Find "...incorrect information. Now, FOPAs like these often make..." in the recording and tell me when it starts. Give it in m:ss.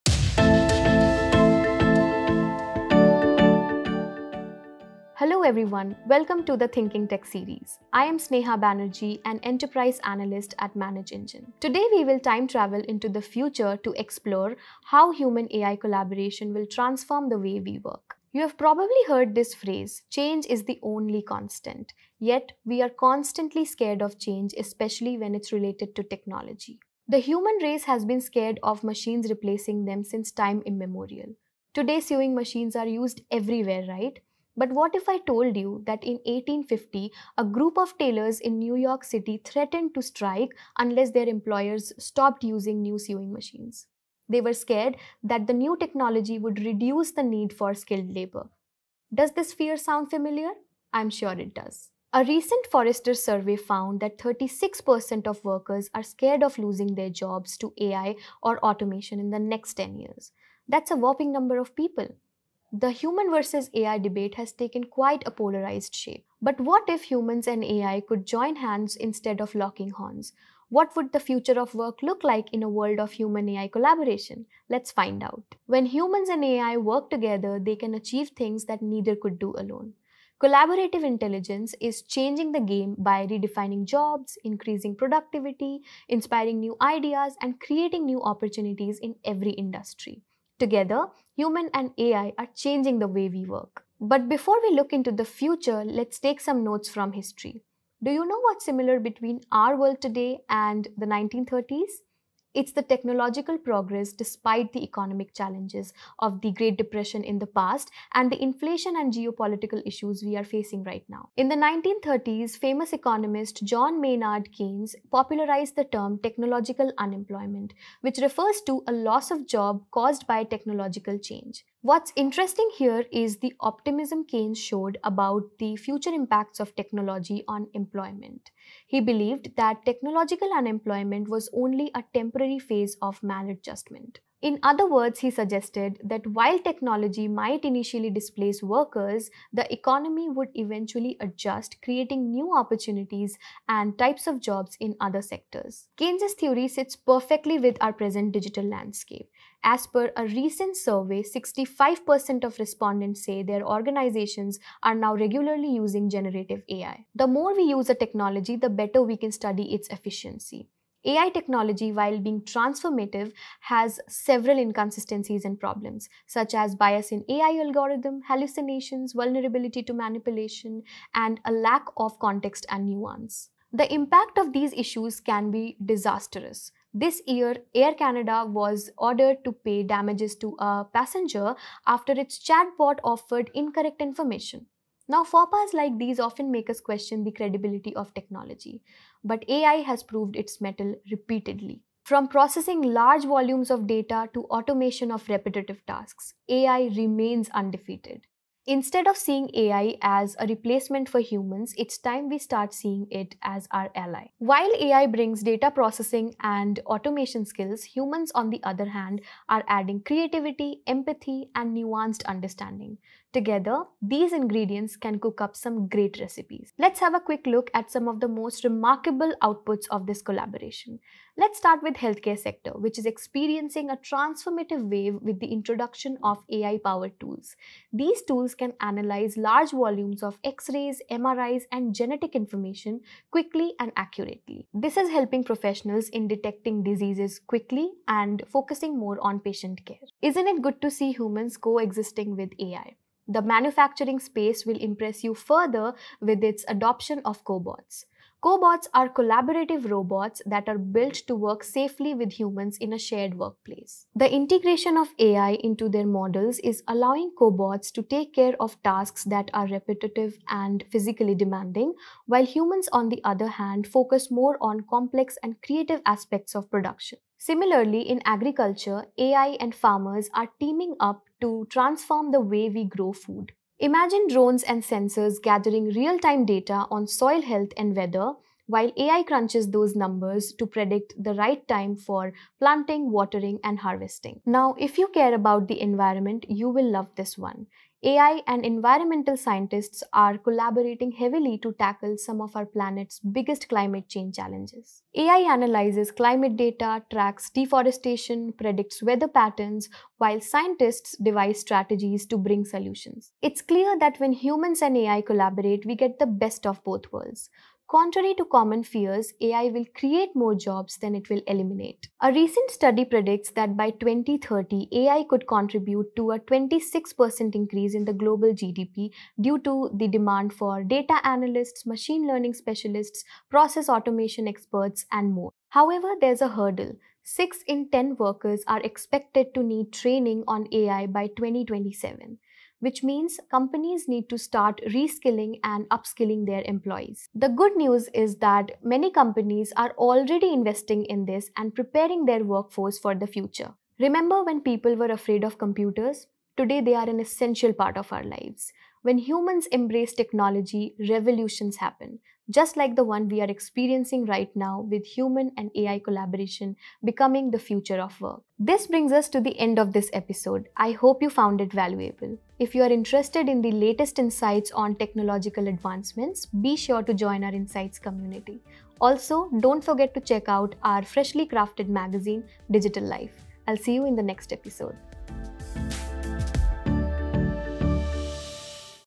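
3:03.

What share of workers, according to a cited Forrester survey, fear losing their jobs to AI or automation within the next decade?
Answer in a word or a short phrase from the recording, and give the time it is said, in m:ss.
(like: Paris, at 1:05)
36%, at 0:54.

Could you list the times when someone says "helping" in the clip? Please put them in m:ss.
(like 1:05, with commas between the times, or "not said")
3:55.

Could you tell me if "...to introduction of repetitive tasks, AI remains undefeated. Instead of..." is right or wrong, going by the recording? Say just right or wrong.
wrong.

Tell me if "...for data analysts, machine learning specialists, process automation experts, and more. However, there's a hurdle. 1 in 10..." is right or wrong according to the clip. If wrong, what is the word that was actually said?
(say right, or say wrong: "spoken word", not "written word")
wrong: "6", not "1".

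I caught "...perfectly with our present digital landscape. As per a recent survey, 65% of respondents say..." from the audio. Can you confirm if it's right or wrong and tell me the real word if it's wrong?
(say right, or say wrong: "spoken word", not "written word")
right.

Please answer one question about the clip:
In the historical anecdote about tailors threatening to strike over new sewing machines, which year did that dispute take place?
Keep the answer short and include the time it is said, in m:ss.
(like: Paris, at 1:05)
1850, at 0:36.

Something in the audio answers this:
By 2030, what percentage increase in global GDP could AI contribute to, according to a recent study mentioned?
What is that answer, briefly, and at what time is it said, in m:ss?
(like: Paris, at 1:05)
26%, at 5:16.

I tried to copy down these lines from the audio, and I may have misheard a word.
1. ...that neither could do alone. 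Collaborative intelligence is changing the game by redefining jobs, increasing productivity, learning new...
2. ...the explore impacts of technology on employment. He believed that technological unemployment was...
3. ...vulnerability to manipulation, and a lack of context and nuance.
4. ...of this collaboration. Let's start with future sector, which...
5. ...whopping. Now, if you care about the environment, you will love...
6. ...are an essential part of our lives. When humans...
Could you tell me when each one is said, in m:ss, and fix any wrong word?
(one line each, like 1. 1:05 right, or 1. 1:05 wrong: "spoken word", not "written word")
1. 1:18 wrong: "inspiring", not "learning"
2. 2:05 wrong: "future", not "explore"
3. 2:49 right
4. 3:39 wrong: "healthcare", not "future"
5. 4:43 wrong: "harvesting", not "whopping"
6. 5:46 right.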